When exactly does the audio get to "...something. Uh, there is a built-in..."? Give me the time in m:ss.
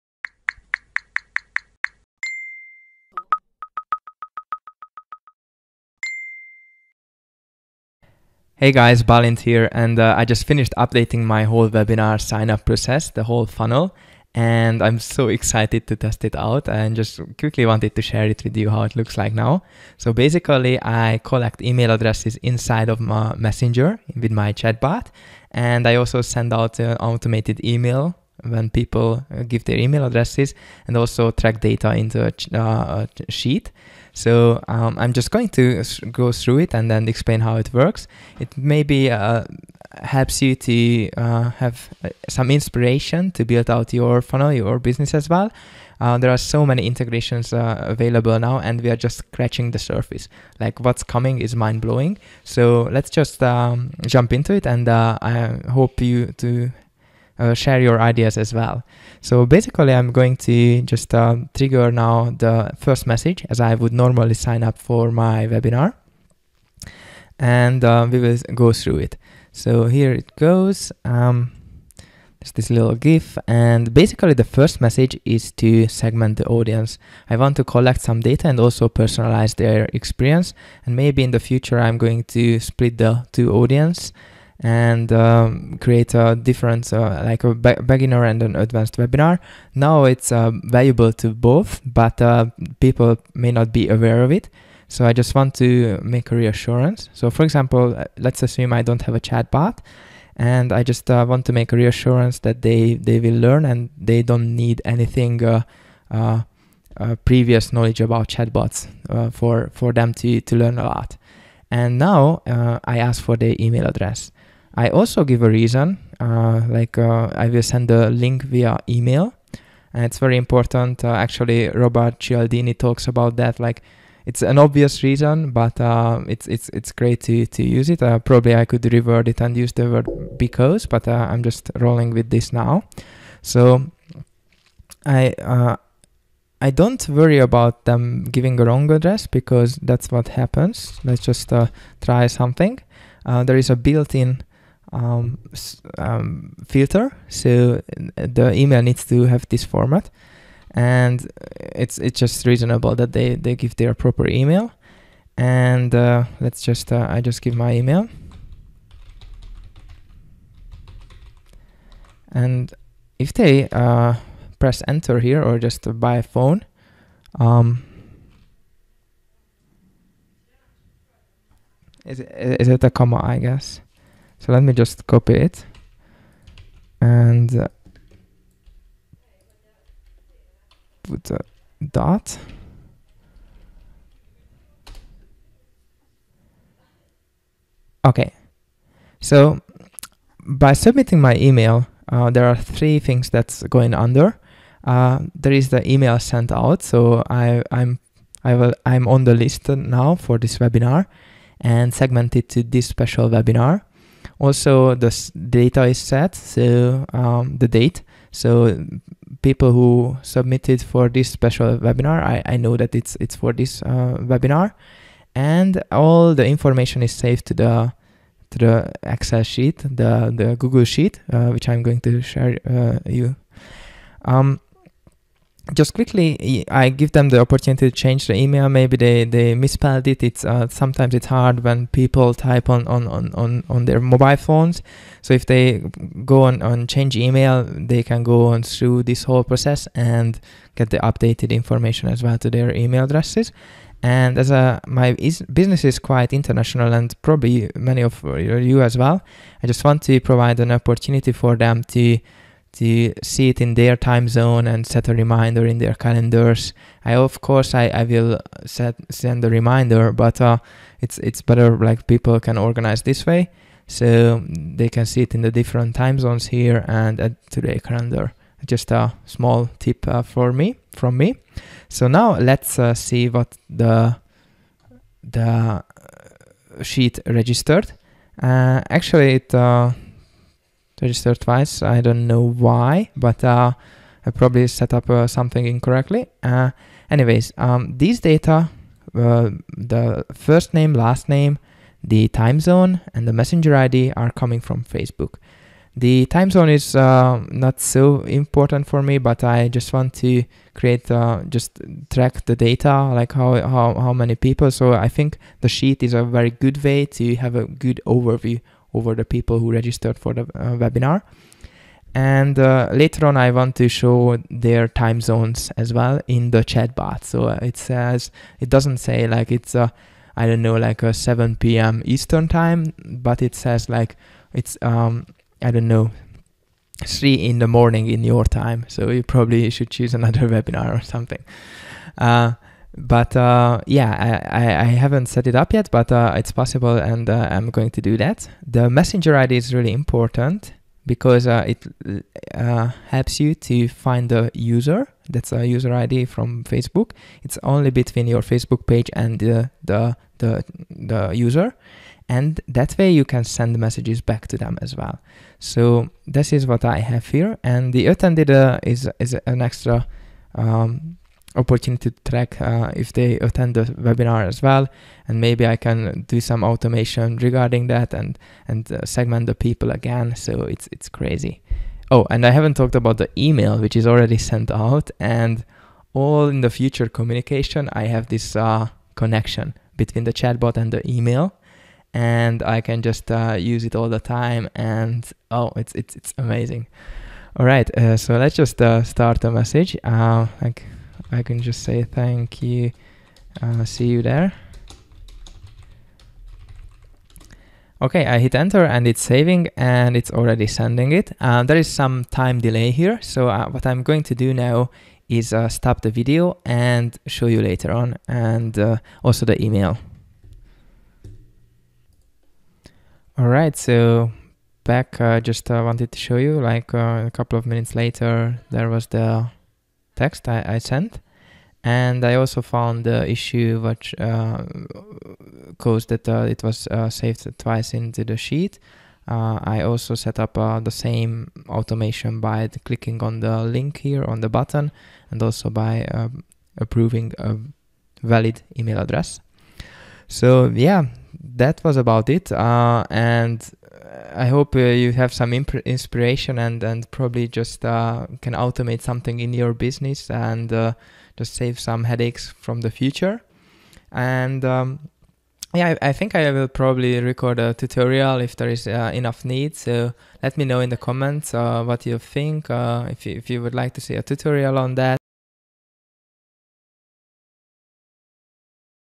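2:22.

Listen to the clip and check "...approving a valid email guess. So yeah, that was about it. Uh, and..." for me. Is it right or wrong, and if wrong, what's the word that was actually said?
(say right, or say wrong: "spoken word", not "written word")
wrong: "address", not "guess".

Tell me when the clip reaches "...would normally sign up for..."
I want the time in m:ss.
1:03.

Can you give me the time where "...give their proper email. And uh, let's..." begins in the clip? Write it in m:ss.
2:33.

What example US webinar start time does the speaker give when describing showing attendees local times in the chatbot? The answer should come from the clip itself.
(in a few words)
7 p.m. Eastern.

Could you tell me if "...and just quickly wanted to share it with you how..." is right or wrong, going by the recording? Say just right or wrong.
right.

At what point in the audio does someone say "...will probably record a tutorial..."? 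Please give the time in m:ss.
7:36.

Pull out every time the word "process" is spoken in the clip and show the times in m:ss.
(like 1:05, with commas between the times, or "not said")
0:12, 3:59.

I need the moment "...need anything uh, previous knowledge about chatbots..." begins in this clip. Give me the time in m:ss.
1:44.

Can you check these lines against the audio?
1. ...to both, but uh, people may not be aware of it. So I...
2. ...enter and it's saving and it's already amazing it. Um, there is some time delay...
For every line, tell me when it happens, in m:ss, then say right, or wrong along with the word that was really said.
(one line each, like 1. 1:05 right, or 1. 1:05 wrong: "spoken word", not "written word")
1. 1:31 right
2. 6:38 wrong: "sending", not "amazing".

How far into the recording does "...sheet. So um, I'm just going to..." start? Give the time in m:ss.
0:33.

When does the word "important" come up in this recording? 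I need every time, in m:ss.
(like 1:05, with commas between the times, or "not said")
2:00, 4:58, 5:39.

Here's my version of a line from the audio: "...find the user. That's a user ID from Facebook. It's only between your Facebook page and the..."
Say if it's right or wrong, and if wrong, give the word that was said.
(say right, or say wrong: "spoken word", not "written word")
right.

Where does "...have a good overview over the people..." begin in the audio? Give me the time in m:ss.
5:07.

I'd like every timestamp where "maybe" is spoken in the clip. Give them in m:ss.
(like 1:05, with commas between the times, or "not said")
0:38, 1:20, 3:48, 6:05.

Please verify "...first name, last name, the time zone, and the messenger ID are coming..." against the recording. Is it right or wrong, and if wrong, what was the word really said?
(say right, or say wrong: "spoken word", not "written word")
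right.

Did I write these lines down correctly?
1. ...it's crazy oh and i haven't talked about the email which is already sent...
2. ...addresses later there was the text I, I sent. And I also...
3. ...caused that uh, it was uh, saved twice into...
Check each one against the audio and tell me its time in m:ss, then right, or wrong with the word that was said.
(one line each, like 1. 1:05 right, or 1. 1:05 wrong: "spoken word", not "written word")
1. 6:10 right
2. 6:57 wrong: "minutes", not "addresses"
3. 7:05 right.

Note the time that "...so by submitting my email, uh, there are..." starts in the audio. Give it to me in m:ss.
3:09.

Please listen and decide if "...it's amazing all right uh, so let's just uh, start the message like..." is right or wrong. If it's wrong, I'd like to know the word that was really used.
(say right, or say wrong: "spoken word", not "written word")
right.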